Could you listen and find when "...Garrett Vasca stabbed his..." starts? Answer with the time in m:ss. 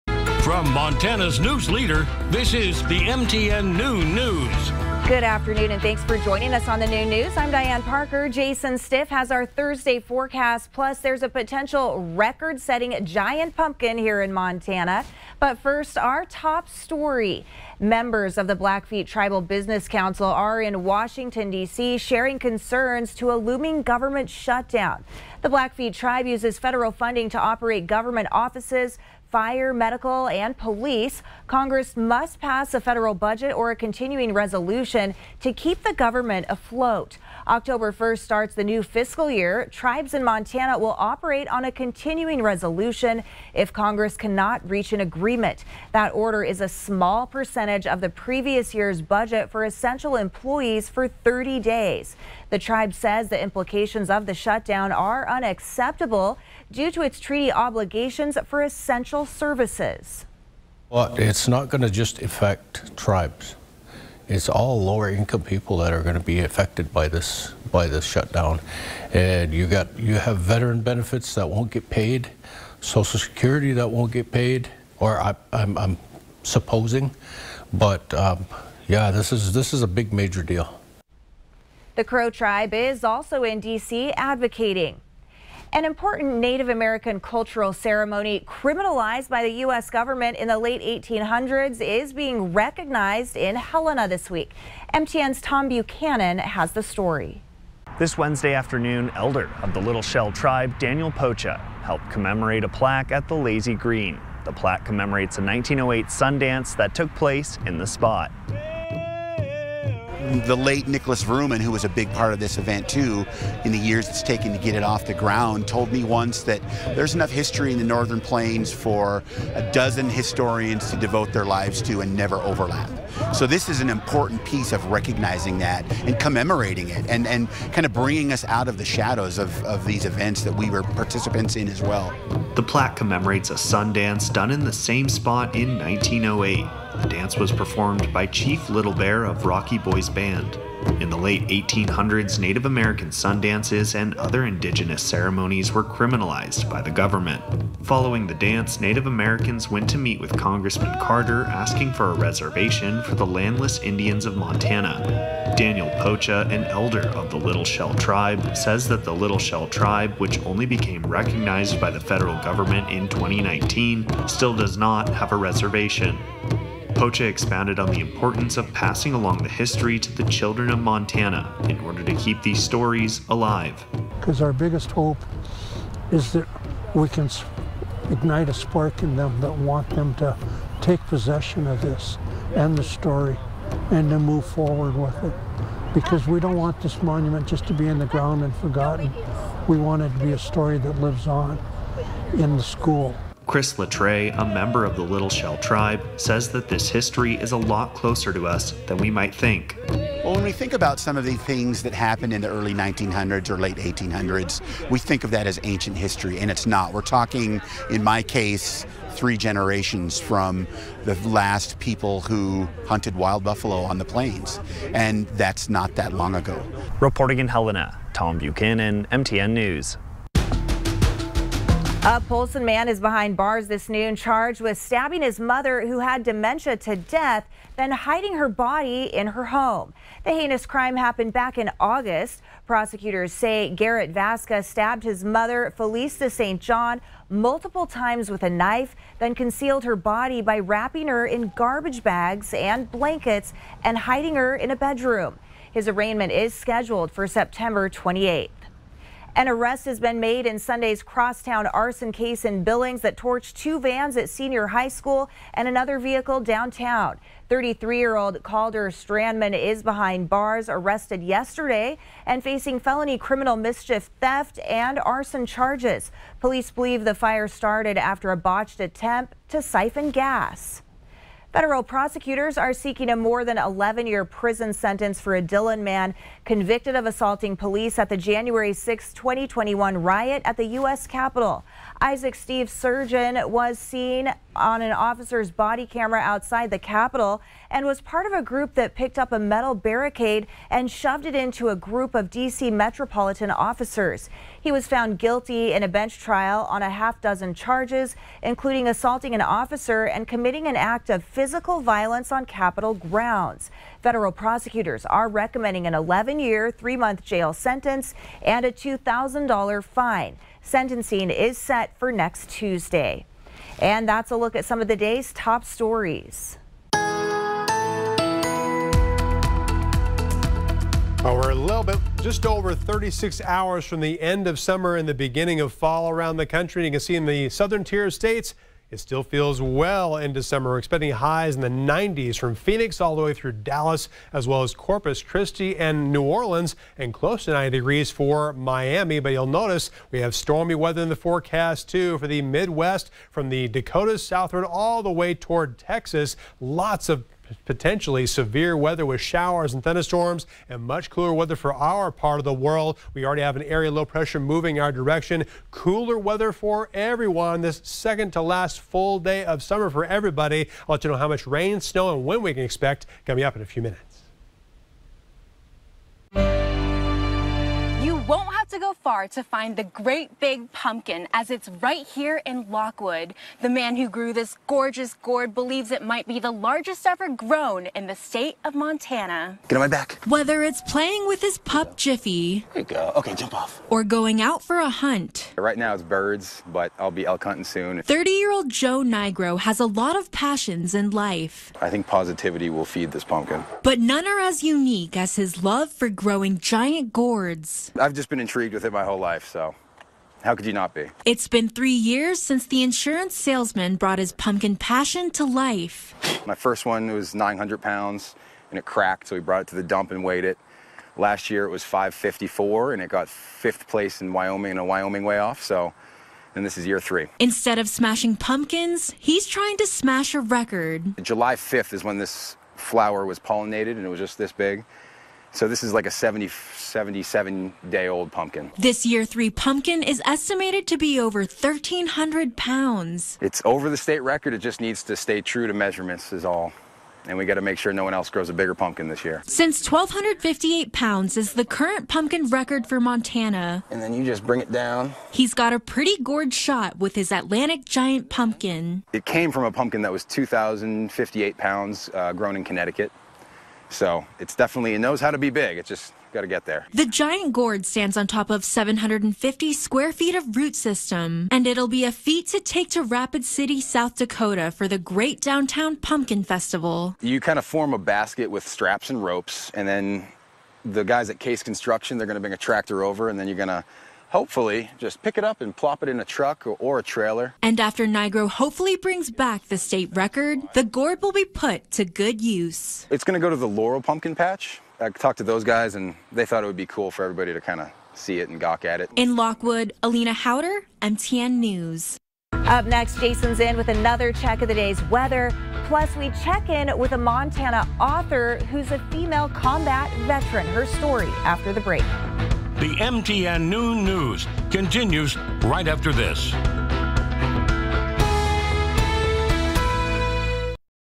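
3:53.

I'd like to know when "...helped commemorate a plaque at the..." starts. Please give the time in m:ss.
1:41.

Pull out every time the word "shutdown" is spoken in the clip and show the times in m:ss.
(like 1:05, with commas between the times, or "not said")
0:24, 0:54, 1:08.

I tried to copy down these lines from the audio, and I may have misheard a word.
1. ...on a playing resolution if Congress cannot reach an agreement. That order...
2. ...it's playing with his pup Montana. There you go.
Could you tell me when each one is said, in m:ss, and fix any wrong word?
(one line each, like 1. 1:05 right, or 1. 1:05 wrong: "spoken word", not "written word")
1. 0:41 wrong: "continuing", not "playing"
2. 6:20 wrong: "Jiffy", not "Montana".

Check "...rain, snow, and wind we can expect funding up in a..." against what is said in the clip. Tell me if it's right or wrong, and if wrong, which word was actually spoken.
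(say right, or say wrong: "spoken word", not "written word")
wrong: "coming", not "funding".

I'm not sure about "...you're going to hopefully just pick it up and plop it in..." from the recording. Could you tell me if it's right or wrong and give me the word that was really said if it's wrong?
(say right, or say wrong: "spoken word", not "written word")
right.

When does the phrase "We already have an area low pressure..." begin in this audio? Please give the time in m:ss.
5:53.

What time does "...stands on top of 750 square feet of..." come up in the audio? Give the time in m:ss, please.
7:37.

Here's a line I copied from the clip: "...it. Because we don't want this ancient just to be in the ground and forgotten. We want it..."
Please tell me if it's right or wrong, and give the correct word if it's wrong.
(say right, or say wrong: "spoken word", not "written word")
wrong: "monument", not "ancient".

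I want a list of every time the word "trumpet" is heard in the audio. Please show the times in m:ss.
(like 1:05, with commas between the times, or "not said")
not said.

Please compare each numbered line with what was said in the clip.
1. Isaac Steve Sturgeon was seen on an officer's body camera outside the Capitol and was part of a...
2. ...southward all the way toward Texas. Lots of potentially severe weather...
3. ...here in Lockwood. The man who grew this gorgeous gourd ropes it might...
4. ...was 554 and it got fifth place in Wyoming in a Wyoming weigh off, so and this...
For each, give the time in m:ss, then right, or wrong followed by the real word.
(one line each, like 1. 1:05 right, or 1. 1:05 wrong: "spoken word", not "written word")
1. 4:42 right
2. 5:44 right
3. 6:12 wrong: "believes", not "ropes"
4. 6:51 right.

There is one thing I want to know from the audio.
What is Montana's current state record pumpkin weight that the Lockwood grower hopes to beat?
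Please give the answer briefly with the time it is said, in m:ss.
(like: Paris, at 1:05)
1,258 pounds, at 7:19.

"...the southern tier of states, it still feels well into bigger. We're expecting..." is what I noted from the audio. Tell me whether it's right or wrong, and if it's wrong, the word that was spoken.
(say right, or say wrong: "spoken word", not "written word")
wrong: "summer", not "bigger".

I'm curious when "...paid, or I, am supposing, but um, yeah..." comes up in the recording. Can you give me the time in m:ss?
1:14.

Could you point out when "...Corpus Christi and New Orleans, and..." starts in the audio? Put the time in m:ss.
5:34.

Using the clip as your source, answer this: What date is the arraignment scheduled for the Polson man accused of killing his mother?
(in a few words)
September 28.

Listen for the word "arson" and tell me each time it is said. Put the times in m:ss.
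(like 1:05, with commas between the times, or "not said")
4:11, 4:24.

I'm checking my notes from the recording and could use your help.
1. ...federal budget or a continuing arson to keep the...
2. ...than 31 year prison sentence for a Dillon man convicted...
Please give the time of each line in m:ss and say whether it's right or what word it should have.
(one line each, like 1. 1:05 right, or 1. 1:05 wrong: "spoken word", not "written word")
1. 0:32 wrong: "resolution", not "arson"
2. 4:33 wrong: "11", not "31".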